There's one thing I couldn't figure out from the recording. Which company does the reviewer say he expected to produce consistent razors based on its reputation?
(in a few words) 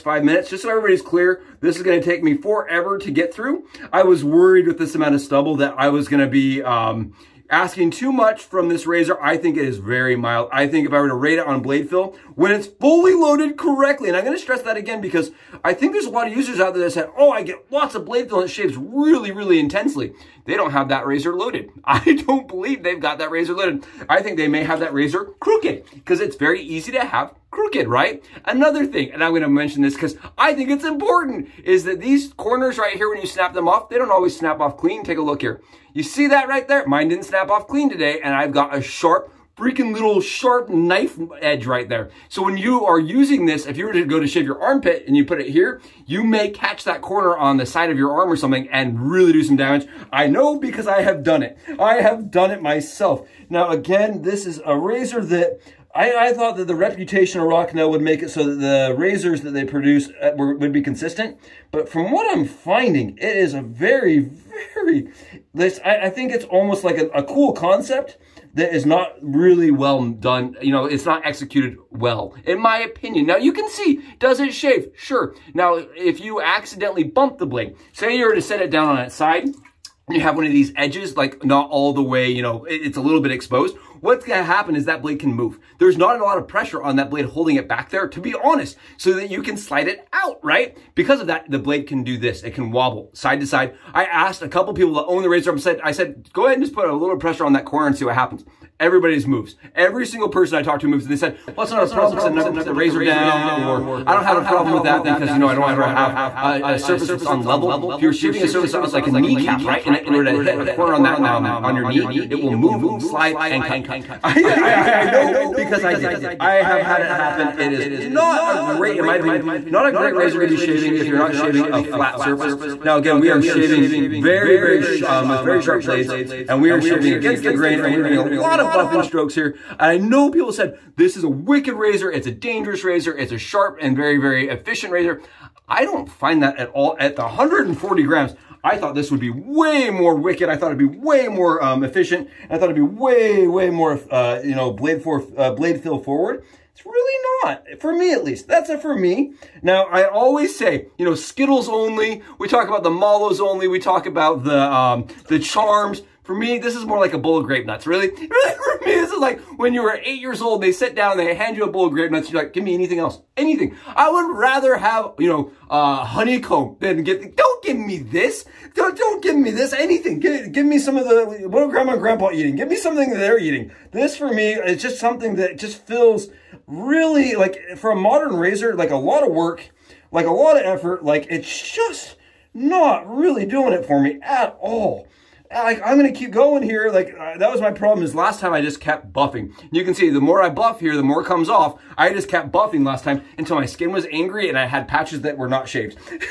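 Rocnel.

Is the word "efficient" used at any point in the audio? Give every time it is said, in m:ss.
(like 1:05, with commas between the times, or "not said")
2:14, 2:21.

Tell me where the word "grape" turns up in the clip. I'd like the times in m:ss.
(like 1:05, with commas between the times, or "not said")
2:37, 2:41.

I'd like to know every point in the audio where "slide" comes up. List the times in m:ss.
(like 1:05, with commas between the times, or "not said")
1:29, 1:52.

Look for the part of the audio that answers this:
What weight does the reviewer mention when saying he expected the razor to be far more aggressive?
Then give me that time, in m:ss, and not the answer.
2:17.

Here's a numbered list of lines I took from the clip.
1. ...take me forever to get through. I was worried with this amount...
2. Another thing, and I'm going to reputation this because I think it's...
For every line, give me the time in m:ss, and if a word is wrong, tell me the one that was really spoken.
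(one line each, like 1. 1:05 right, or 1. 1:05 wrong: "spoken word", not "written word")
1. 0:02 right
2. 0:28 wrong: "mention", not "reputation".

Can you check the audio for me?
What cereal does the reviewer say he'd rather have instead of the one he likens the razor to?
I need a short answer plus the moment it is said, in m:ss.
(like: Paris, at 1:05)
Honeycomb, at 2:46.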